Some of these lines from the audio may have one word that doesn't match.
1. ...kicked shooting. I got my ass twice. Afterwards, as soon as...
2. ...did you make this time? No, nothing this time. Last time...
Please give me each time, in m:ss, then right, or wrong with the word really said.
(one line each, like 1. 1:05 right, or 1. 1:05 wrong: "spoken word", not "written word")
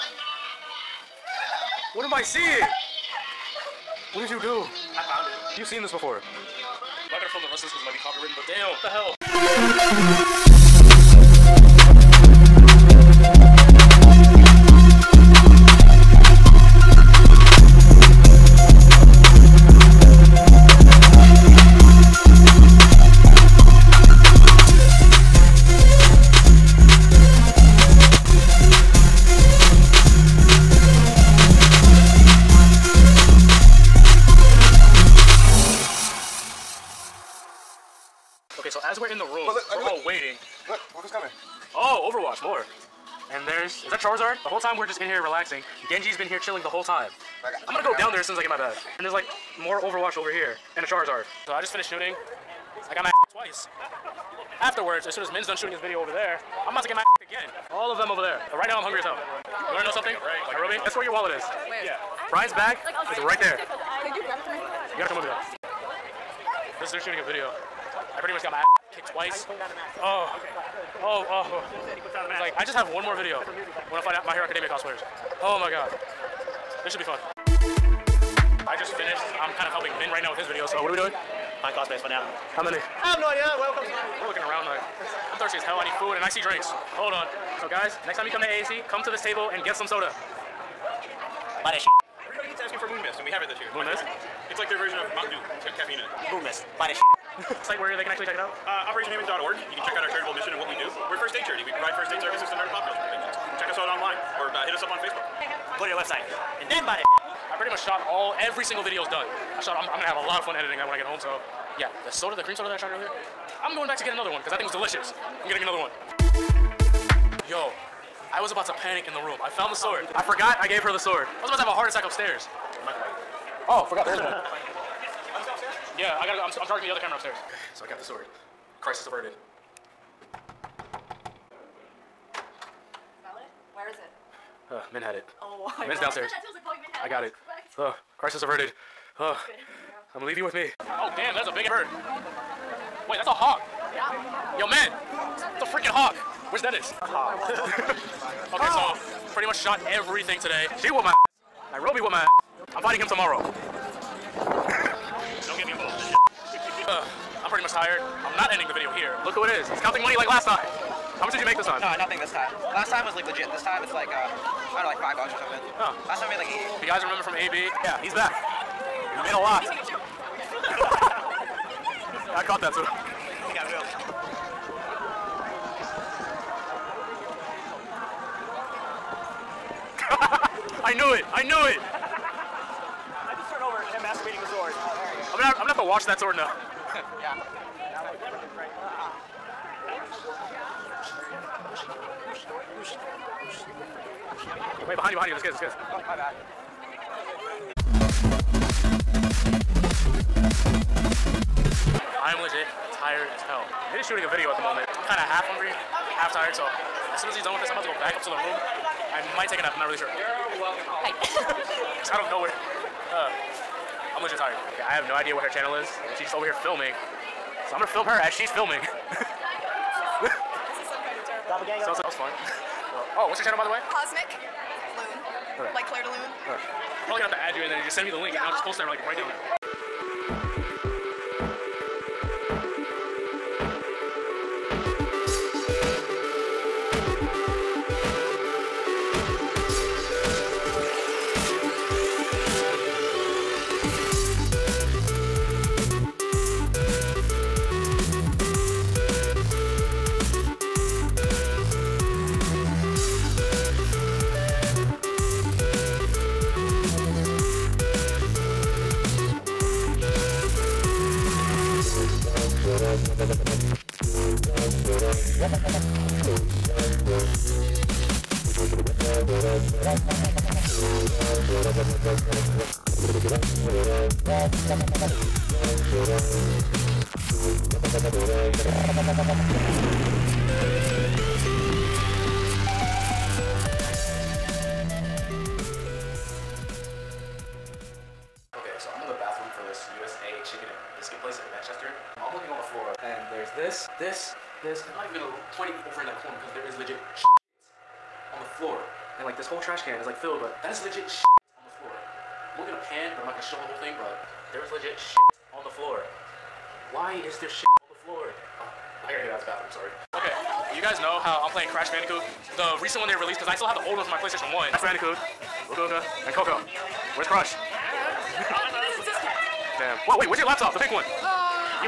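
1. 0:51 wrong: "finished", not "kicked"
2. 2:41 right.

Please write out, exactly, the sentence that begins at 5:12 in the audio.
The recent one they released, because I still have the old one from my PlayStation 1.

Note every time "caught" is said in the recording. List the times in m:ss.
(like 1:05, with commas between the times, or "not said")
2:52.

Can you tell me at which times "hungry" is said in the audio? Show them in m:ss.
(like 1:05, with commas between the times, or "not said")
0:58, 3:25.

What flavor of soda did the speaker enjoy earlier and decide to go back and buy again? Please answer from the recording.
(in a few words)
cream soda.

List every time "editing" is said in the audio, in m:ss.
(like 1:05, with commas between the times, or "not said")
1:50.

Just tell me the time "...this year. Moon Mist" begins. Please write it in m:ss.
1:33.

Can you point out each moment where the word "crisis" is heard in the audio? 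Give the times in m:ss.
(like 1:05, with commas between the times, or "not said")
2:08, 2:18.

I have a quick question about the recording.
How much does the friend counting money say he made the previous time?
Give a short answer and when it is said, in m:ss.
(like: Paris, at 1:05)
80, at 2:46.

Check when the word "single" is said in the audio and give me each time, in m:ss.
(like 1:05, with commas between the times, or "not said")
1:48.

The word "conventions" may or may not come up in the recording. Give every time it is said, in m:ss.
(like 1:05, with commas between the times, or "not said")
1:42.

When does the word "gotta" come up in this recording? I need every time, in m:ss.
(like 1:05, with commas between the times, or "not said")
1:04, 2:06, 5:09.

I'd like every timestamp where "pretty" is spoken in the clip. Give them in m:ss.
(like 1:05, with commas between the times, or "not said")
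1:08, 1:47, 2:29, 2:37.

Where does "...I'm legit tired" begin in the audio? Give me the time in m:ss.
3:34.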